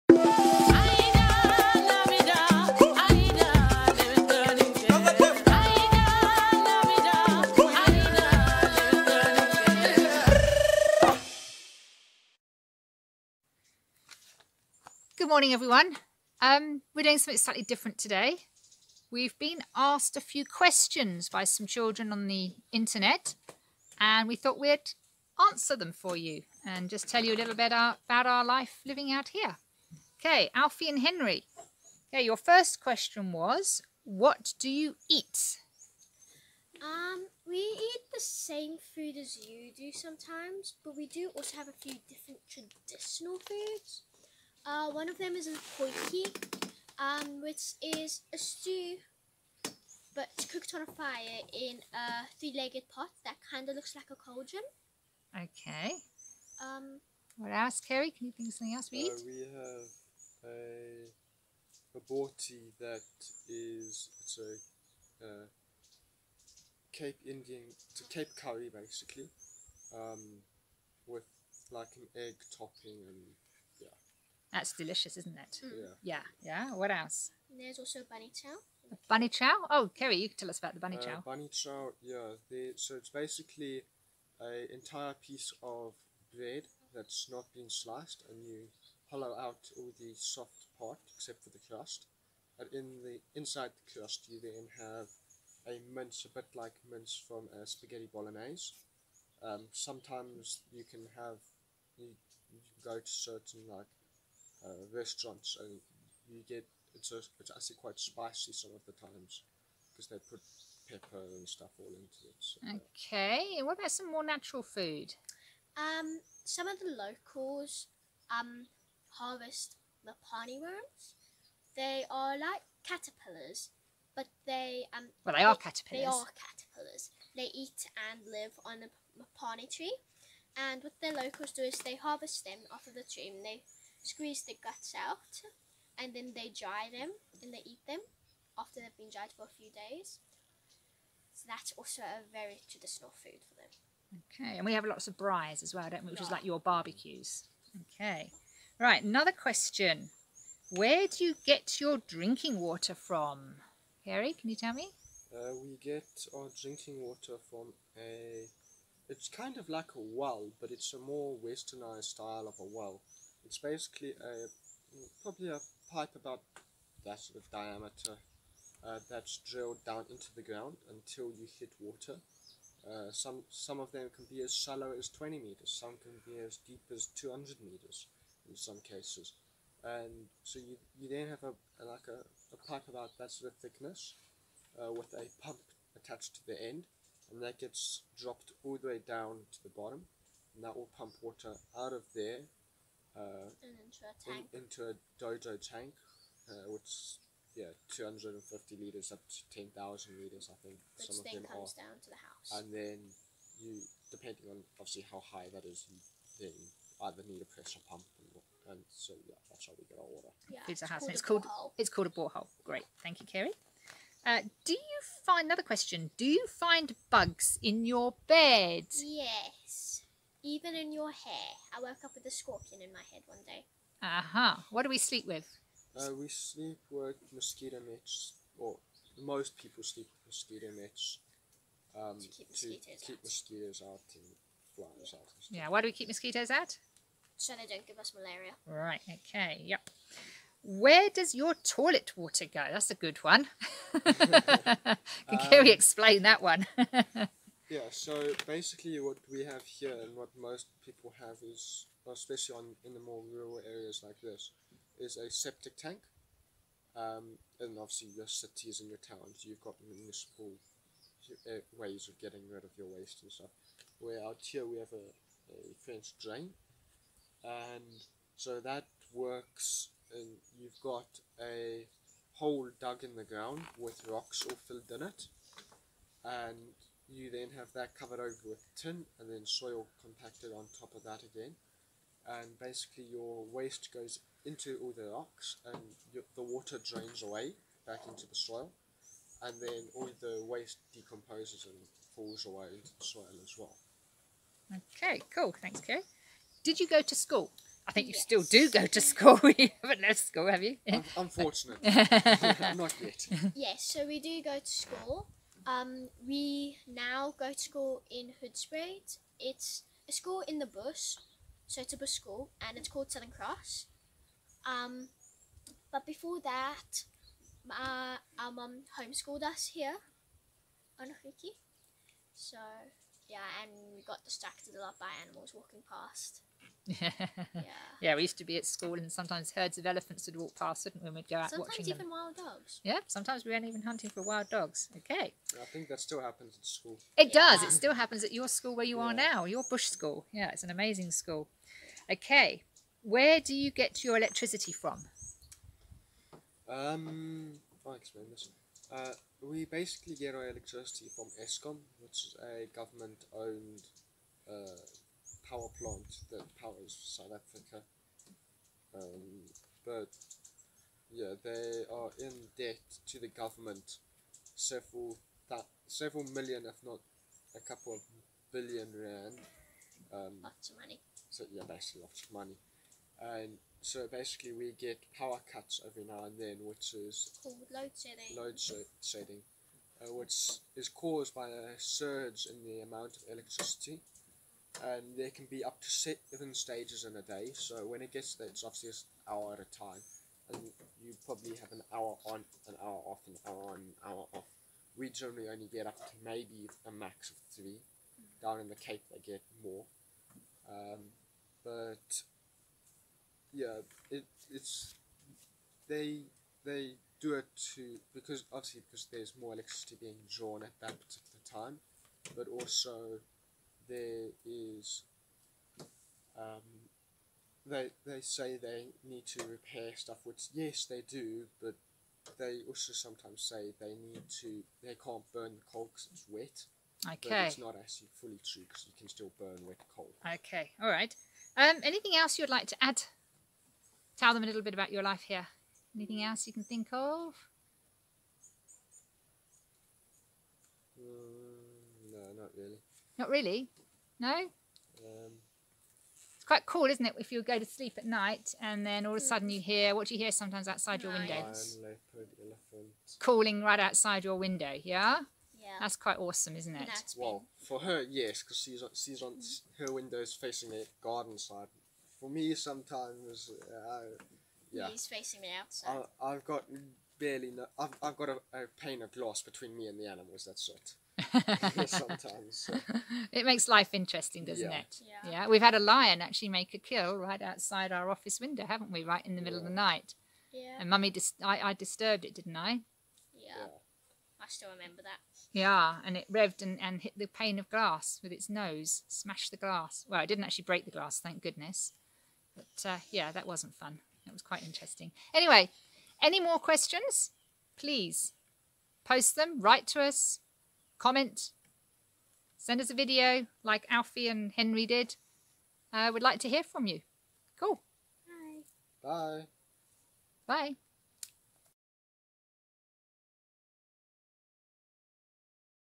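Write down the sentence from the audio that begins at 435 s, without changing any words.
Anything else you can think of?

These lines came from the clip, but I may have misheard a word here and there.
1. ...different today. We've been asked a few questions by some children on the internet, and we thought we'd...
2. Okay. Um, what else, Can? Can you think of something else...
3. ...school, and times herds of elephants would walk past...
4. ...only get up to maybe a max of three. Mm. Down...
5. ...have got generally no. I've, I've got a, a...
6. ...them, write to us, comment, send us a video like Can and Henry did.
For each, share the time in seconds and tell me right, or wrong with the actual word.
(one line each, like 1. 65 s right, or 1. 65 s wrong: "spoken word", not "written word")
1. 17 s right
2. 55 s wrong: "Cary", not "Can"
3. 328 s wrong: "sometimes", not "times"
4. 395 s right
5. 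466 s wrong: "barely", not "generally"
6. 499 s wrong: "Alfie", not "Can".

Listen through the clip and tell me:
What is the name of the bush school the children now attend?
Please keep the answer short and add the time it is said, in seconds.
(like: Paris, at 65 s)
Southern Cross, at 313 s.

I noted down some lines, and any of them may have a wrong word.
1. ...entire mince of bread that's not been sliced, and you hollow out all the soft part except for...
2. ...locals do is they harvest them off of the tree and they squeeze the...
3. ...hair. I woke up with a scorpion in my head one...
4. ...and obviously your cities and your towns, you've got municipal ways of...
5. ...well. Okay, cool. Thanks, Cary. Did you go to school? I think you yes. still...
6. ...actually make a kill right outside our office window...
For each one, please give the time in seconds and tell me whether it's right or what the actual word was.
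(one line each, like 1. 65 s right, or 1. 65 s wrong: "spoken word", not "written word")
1. 84 s wrong: "piece", not "mince"
2. 131 s right
3. 221 s right
4. 257 s right
5. 293 s right
6. 476 s right.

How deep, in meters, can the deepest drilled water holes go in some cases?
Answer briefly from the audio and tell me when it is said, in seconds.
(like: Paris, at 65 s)
200 meters, at 177 s.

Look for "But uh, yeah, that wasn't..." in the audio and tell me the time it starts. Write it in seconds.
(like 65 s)
492 s.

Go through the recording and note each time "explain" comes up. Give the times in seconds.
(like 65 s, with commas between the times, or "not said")
245 s, 347 s.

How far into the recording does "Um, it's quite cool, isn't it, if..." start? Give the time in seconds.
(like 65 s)
444 s.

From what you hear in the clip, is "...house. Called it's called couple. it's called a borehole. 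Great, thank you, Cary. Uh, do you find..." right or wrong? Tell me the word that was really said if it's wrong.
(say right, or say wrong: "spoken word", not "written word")
wrong: "borehole", not "couple".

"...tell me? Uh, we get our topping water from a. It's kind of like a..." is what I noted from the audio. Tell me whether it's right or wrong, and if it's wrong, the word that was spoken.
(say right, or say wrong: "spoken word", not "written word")
wrong: "drinking", not "topping".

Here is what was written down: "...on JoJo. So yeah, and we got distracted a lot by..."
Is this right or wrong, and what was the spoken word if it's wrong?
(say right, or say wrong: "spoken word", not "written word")
wrong: "Hiki", not "JoJo".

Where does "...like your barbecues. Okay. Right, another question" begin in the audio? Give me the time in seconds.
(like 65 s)
146 s.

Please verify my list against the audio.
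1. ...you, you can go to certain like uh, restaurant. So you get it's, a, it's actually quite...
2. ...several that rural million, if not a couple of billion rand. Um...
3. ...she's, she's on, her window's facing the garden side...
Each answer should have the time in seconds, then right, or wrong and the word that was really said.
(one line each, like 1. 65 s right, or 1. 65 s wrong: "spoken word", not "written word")
1. 101 s right
2. 364 s wrong: "several", not "rural"
3. 458 s right.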